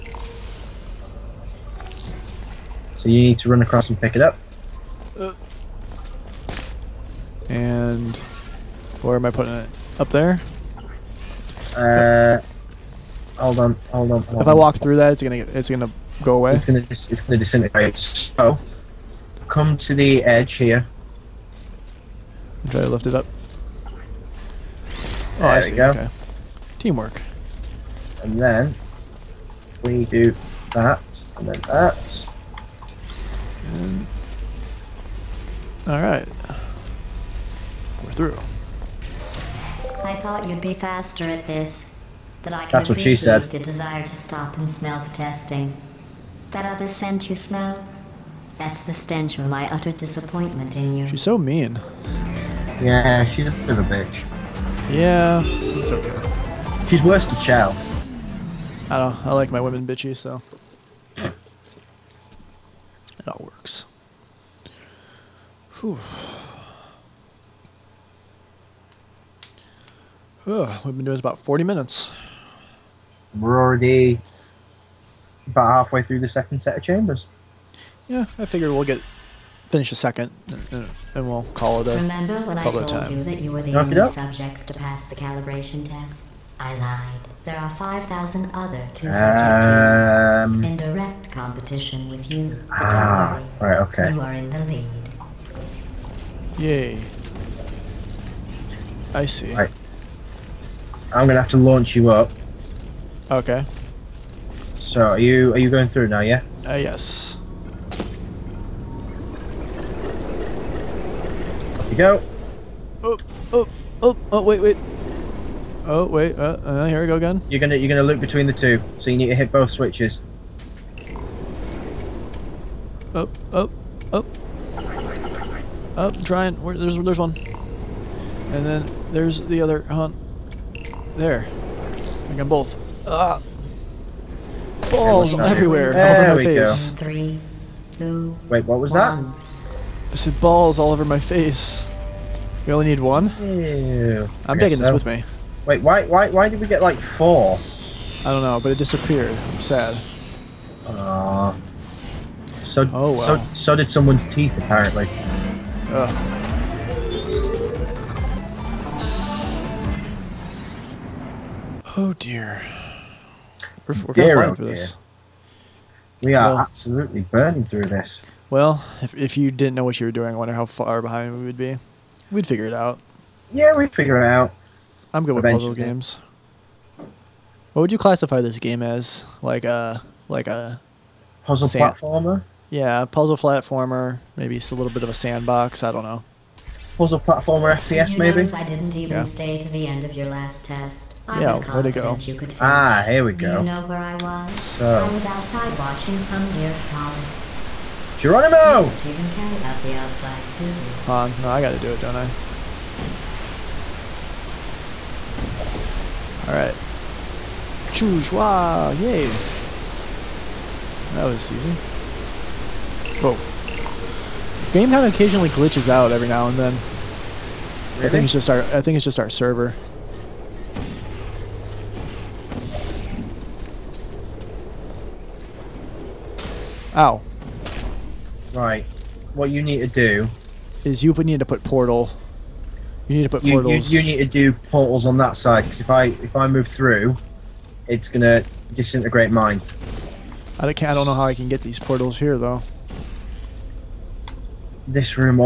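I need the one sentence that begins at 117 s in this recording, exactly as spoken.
You're gonna you're gonna loop between the two, so you need to hit both switches.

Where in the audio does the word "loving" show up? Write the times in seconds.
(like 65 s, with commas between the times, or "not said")
not said.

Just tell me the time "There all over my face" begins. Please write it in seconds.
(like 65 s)
135 s.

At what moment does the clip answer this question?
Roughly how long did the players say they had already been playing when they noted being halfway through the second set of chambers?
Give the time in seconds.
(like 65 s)
71 s.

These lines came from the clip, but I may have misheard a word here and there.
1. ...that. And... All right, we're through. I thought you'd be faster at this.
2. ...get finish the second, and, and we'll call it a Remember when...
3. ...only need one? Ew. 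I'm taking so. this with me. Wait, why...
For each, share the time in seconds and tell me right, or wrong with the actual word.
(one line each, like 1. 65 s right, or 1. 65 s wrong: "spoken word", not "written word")
1. 31 s right
2. 78 s right
3. 142 s right.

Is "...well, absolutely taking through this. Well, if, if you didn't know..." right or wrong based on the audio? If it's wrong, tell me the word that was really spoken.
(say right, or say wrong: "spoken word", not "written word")
wrong: "burning", not "taking".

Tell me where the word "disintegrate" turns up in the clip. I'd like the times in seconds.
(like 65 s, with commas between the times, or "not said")
17 s, 238 s.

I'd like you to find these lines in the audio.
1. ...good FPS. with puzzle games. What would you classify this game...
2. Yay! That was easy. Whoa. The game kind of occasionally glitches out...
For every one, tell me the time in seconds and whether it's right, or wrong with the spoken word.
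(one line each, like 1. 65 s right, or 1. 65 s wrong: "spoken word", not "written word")
1. 175 s wrong: "Eventually", not "FPS"
2. 208 s right.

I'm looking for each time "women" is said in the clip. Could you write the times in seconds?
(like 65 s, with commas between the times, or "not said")
59 s.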